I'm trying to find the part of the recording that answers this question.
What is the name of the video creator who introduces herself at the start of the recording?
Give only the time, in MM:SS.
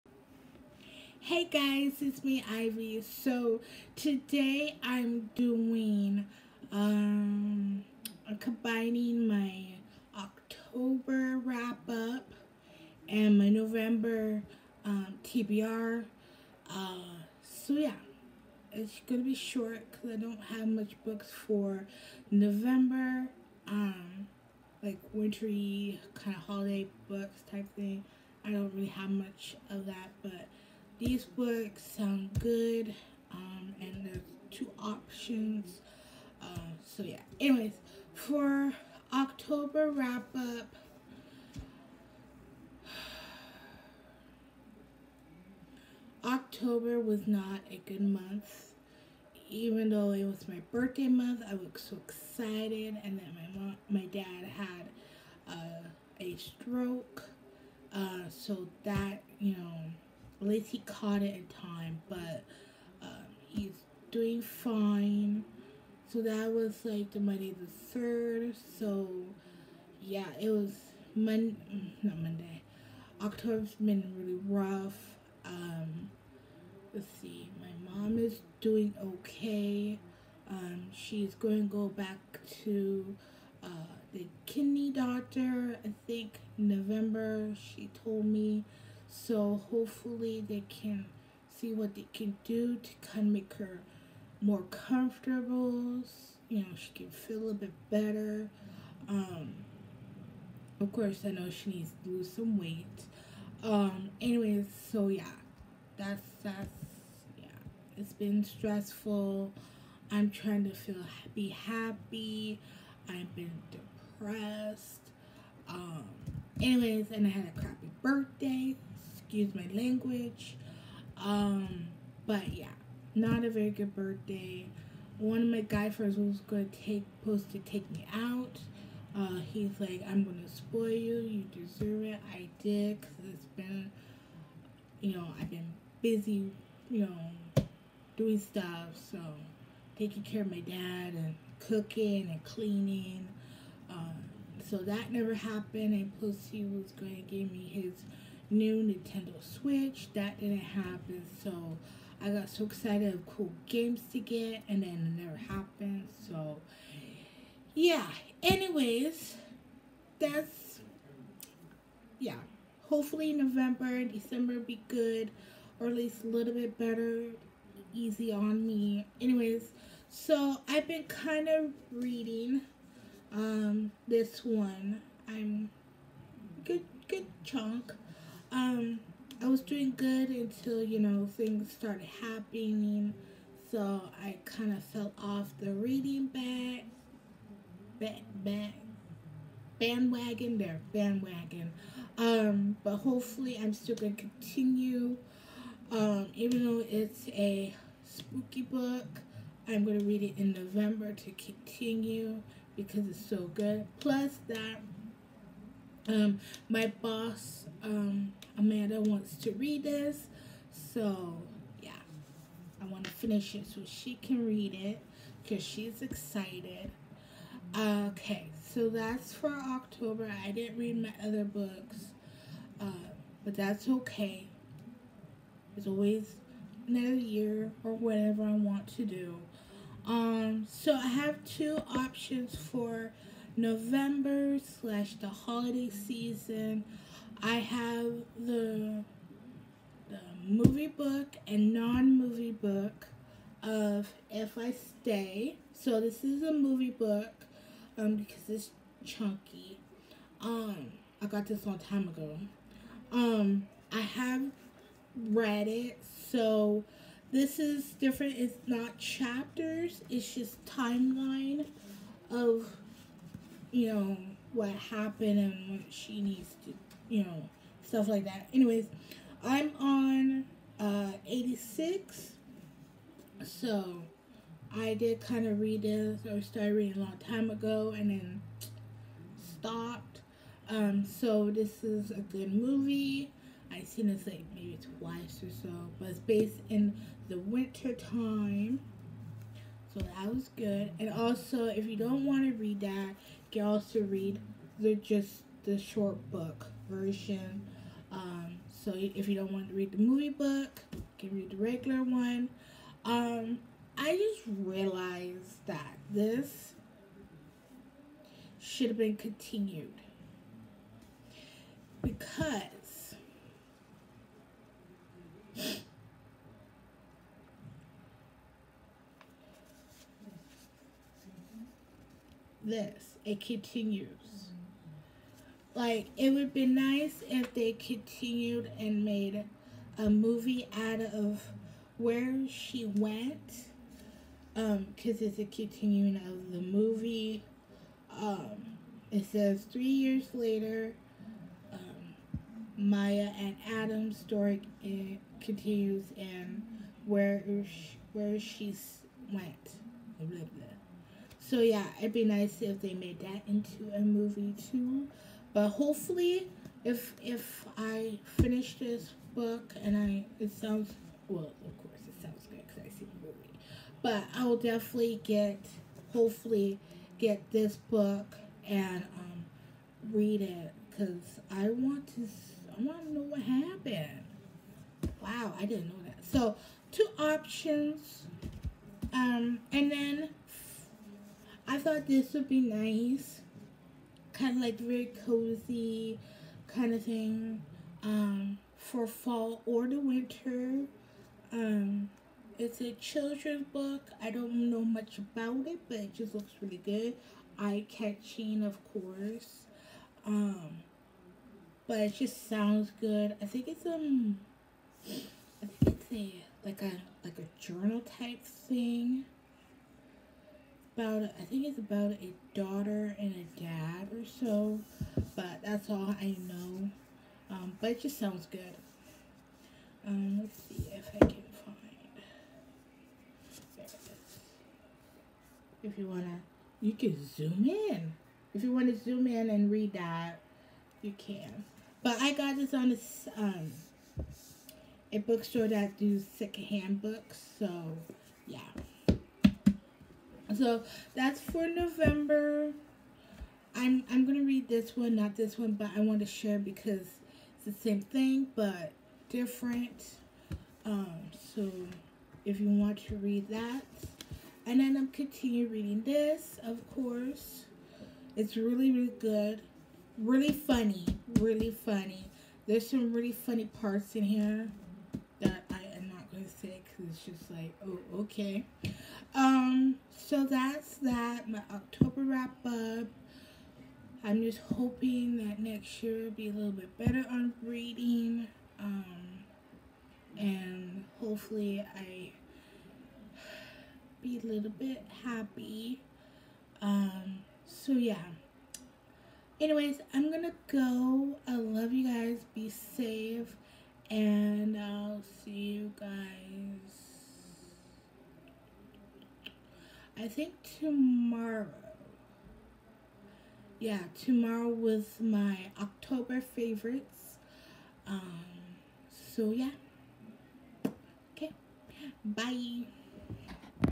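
00:02.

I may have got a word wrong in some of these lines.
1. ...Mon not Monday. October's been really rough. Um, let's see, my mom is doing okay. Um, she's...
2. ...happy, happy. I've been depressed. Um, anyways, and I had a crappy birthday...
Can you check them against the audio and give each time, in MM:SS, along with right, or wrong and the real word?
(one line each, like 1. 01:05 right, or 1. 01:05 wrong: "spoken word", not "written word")
1. 01:11 right
2. 01:51 right.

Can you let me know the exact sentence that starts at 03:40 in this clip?
I didn't read my other books, uh, but that's okay.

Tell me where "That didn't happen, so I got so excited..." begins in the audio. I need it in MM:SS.
02:30.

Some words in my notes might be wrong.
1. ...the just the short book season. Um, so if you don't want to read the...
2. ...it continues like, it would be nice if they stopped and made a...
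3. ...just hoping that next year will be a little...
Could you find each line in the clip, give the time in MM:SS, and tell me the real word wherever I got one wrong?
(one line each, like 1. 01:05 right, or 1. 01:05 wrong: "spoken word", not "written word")
1. 04:54 wrong: "version", not "season"
2. 05:23 wrong: "continued", not "stopped"
3. 07:54 right.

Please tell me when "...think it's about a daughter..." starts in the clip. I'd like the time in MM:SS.
06:51.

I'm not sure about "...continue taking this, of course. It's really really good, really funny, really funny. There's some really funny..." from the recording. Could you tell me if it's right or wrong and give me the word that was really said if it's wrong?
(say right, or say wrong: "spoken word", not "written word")
wrong: "reading", not "taking".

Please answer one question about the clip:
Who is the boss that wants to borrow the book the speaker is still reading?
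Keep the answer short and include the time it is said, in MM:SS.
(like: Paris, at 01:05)
Amanda, at 03:28.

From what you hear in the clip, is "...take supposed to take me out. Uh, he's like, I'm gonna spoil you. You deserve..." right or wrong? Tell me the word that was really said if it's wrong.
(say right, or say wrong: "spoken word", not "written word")
right.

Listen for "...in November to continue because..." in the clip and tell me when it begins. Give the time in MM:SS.
03:20.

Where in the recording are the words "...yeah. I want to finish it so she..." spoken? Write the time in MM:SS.
03:31.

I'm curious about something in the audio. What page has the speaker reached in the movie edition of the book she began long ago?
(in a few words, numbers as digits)
86.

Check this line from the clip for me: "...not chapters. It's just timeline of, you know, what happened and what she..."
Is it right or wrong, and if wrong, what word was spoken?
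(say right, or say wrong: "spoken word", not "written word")
right.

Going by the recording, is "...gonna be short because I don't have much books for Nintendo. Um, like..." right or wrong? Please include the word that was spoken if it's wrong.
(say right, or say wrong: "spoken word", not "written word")
wrong: "November", not "Nintendo".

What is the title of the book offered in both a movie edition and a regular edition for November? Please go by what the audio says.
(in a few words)
If I Stay.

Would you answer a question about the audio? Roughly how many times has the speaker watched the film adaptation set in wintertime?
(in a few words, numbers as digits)
twice.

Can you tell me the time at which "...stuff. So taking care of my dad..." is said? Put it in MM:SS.
02:18.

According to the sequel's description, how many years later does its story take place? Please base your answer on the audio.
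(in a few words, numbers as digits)
3.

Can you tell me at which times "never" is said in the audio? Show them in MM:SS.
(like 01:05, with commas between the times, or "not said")
02:25, 02:35.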